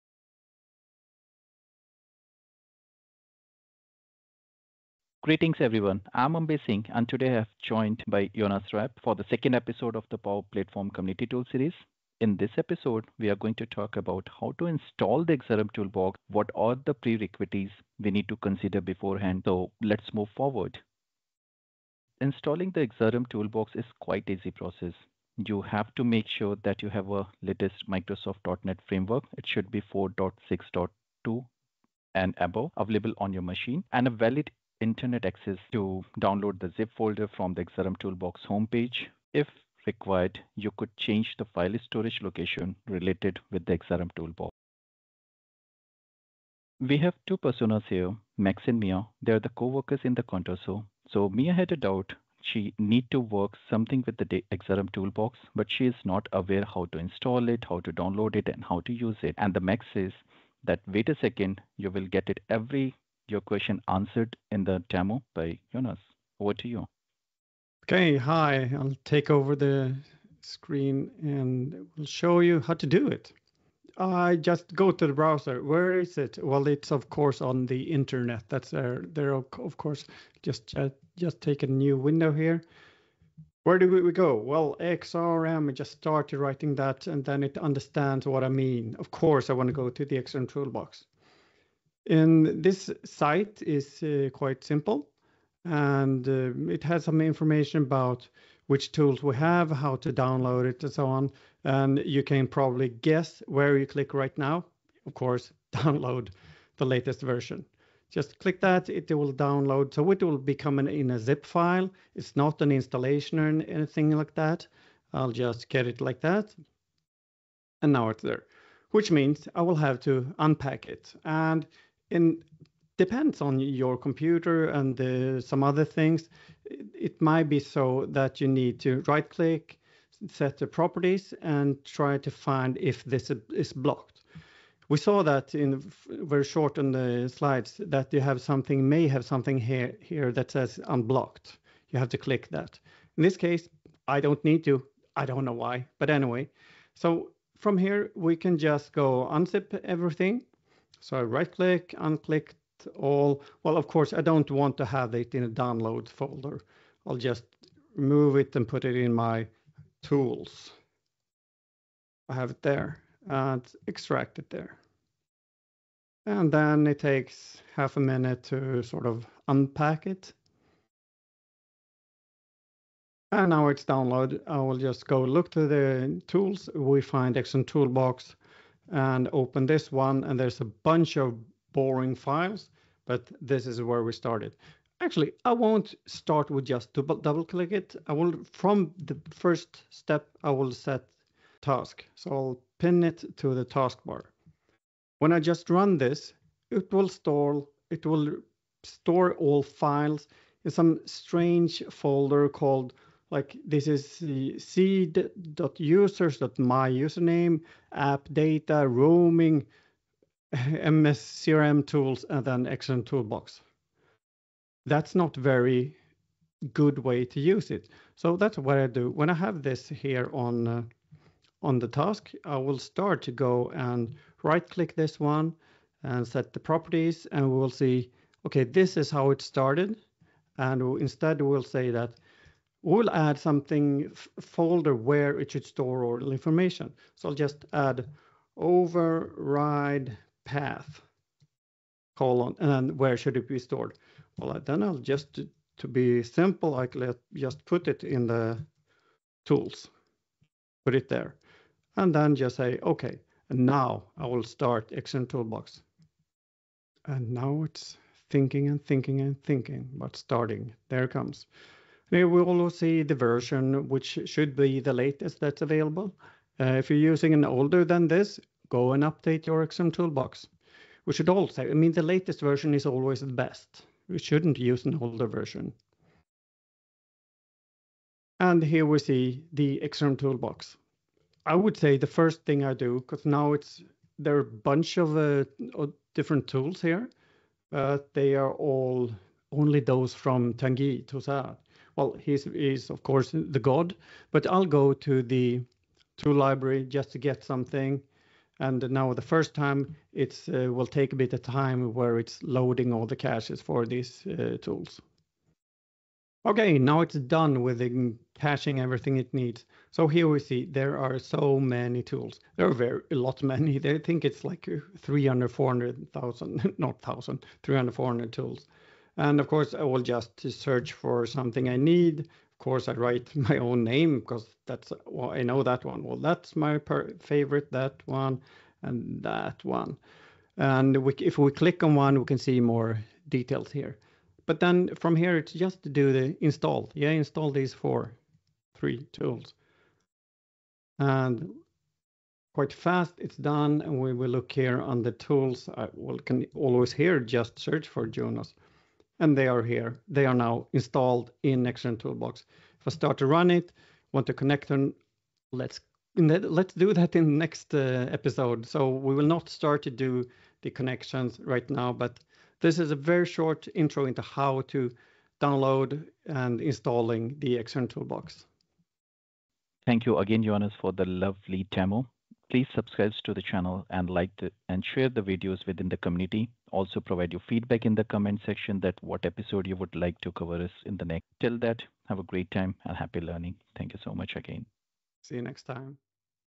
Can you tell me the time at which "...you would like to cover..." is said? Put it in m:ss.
6:19.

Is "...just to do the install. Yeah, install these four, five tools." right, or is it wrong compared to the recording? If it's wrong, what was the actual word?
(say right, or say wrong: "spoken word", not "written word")
wrong: "three", not "five".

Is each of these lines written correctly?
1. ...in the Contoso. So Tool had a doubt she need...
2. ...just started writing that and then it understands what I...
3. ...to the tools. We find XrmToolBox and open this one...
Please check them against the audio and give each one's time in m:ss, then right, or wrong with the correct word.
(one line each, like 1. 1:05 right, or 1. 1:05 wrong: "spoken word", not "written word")
1. 0:50 wrong: "Mia", not "Tool"
2. 1:25 right
3. 2:55 right.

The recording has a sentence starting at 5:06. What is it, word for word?
Okay, now it's done with the caching everything it needs.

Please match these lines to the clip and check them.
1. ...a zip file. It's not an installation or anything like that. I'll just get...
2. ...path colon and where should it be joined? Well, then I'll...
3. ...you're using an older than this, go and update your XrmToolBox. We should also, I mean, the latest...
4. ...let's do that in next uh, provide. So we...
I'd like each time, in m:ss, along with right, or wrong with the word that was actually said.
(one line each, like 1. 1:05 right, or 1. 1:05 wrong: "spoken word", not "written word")
1. 1:51 right
2. 4:00 wrong: "stored", not "joined"
3. 4:26 right
4. 5:56 wrong: "episode", not "provide".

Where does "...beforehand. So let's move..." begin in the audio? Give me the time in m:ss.
0:18.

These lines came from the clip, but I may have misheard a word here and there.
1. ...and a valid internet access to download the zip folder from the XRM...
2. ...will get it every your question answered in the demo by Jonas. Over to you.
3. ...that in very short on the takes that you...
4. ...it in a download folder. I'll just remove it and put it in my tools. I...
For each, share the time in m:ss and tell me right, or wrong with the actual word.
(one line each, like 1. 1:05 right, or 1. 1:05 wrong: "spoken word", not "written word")
1. 0:33 right
2. 1:01 right
3. 2:15 wrong: "slides", not "takes"
4. 2:35 right.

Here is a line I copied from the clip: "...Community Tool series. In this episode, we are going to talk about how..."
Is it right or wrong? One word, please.
right.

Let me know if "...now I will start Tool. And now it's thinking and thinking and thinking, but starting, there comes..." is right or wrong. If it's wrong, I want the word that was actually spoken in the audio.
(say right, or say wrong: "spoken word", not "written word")
wrong: "XrmToolBox", not "Tool".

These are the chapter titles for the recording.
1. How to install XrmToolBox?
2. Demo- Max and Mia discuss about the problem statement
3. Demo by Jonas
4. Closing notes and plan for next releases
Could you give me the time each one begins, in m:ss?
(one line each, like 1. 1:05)
1. 0:22
2. 0:46
3. 1:13
4. 6:09.